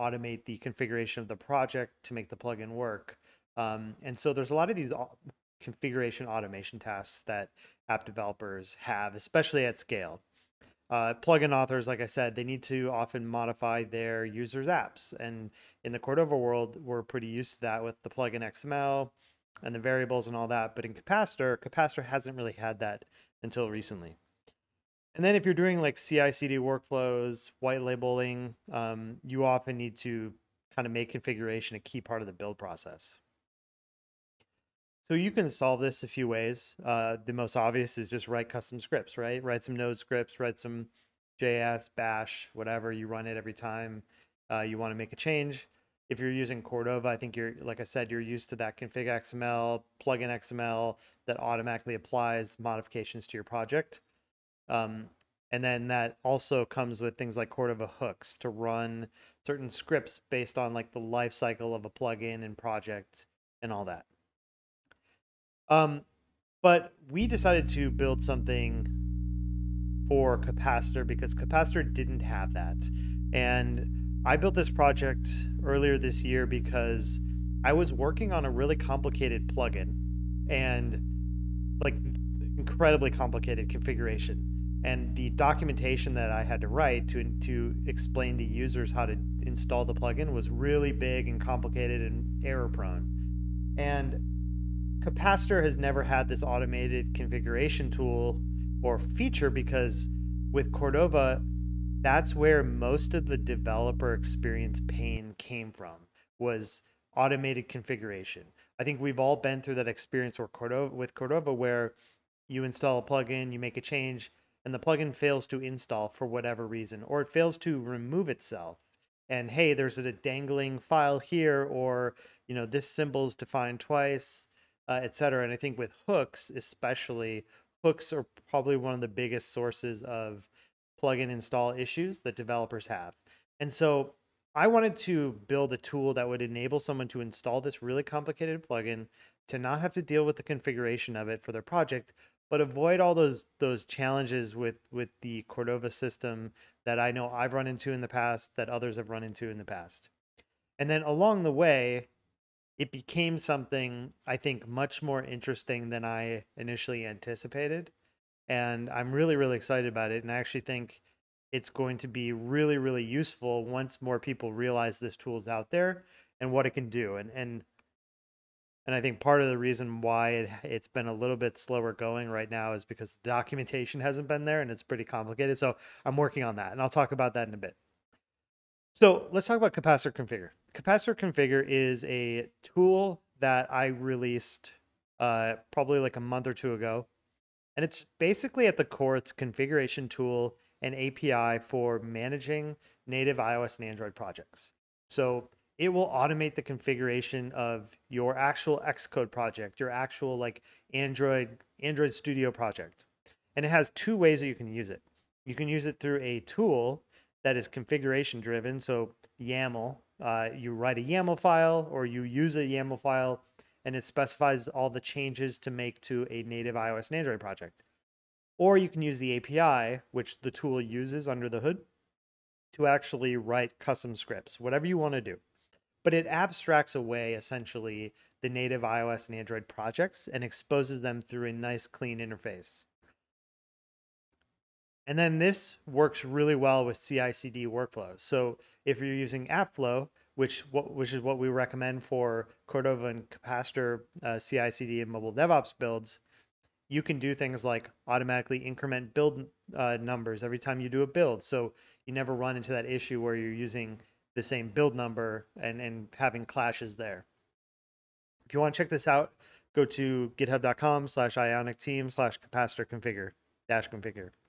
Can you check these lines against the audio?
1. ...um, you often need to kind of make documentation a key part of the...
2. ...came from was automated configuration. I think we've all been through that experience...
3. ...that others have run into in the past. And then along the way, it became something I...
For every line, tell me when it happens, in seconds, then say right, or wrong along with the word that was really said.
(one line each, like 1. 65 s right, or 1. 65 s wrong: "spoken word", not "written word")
1. 28 s wrong: "configuration", not "documentation"
2. 105 s right
3. 148 s right.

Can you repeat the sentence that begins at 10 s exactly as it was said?
Uh, plugin authors, like I said, they need to often modify their users' apps.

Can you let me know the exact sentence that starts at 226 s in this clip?
But it abstracts away essentially the native iOS and Android projects and exposes them through a nice clean interface.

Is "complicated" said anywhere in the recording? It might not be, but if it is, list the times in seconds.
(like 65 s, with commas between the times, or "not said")
78 s, 83 s, 91 s, 138 s, 175 s.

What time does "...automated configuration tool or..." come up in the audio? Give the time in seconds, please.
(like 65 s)
96 s.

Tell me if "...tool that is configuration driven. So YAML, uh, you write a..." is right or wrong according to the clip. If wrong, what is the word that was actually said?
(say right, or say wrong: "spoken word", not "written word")
right.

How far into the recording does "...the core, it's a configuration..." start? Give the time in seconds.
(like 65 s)
188 s.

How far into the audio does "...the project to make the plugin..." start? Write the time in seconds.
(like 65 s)
1 s.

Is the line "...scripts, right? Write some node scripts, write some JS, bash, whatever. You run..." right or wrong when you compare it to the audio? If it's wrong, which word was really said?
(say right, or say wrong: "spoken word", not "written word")
right.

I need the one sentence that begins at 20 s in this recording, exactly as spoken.
But in capacitor, capacitor hasn't really had that until recently.